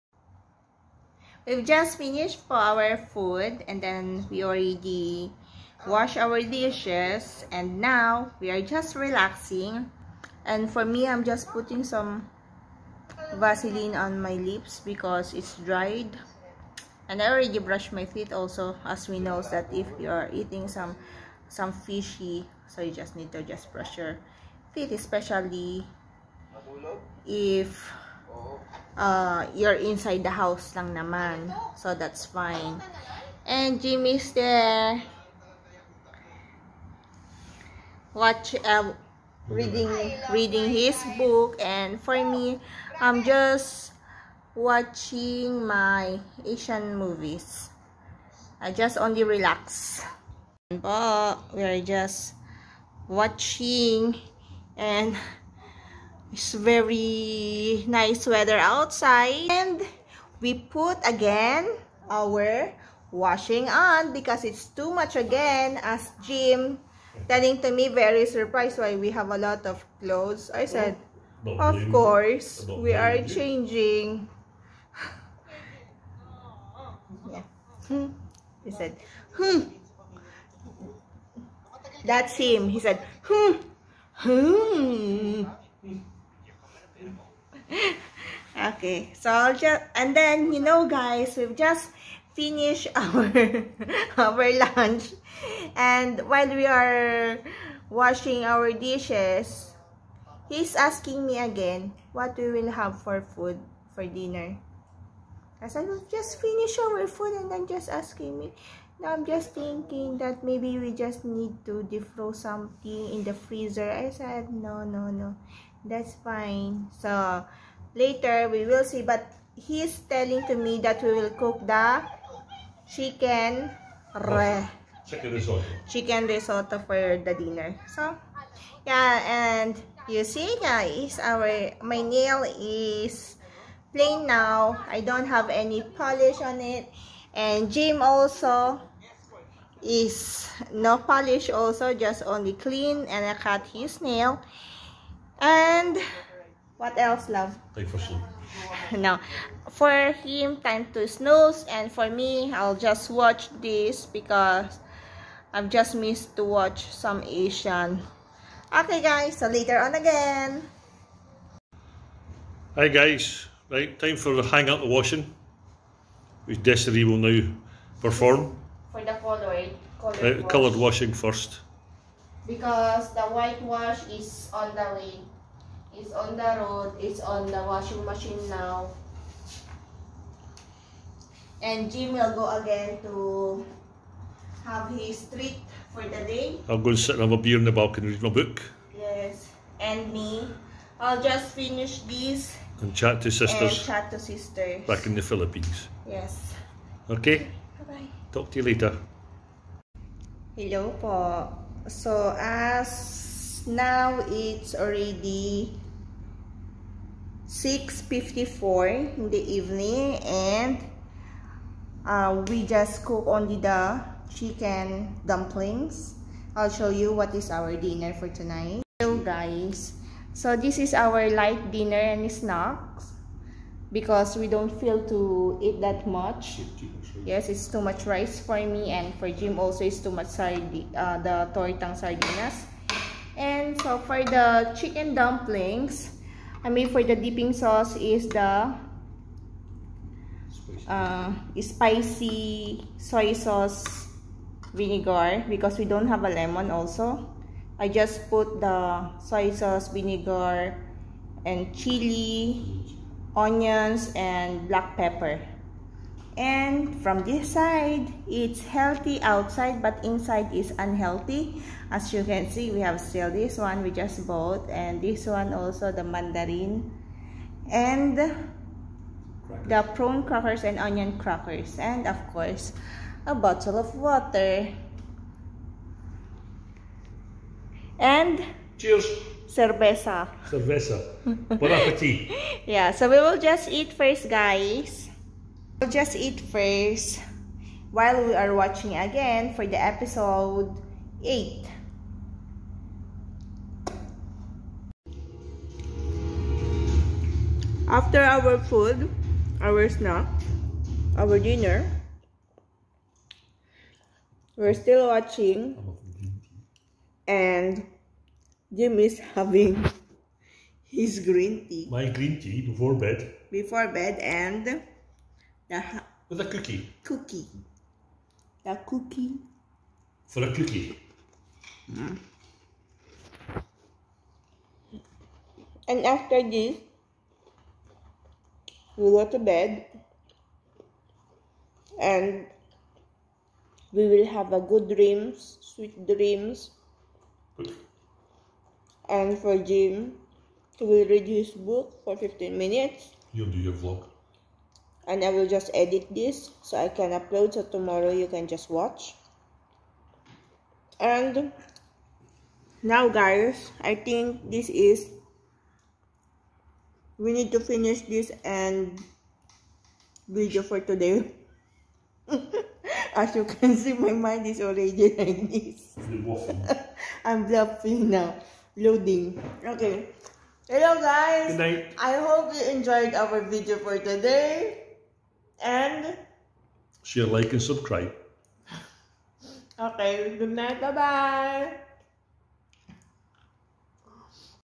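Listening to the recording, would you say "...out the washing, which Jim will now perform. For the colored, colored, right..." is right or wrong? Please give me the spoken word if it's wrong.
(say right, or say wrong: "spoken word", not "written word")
wrong: "Desiree", not "Jim".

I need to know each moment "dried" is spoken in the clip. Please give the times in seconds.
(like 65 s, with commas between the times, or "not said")
15 s.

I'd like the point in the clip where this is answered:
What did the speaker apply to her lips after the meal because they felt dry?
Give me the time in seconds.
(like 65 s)
13 s.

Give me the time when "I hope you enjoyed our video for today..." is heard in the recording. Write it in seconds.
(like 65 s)
371 s.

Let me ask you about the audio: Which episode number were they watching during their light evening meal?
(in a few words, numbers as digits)
8.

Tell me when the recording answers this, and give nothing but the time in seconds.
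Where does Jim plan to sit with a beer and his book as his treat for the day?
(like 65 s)
187 s.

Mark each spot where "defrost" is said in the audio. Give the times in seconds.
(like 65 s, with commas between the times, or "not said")
111 s.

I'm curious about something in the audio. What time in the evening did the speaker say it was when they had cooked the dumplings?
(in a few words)
6:54.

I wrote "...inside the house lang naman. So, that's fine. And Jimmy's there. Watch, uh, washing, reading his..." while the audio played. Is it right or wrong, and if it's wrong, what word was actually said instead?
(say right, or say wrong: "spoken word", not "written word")
wrong: "reading", not "washing".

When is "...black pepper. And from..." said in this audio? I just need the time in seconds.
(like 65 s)
254 s.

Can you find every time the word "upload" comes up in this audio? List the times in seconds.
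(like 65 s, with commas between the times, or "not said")
347 s.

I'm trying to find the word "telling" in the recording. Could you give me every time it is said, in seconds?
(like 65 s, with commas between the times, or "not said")
67 s, 120 s.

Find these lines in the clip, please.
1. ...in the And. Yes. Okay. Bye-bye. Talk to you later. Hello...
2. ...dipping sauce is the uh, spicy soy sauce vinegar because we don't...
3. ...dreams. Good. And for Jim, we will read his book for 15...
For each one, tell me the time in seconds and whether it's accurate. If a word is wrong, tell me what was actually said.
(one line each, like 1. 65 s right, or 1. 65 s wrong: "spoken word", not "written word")
1. 195 s wrong: "Philippines", not "And"
2. 237 s right
3. 336 s right.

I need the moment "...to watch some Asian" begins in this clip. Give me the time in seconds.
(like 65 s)
156 s.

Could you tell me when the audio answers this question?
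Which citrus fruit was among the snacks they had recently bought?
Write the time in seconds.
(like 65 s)
266 s.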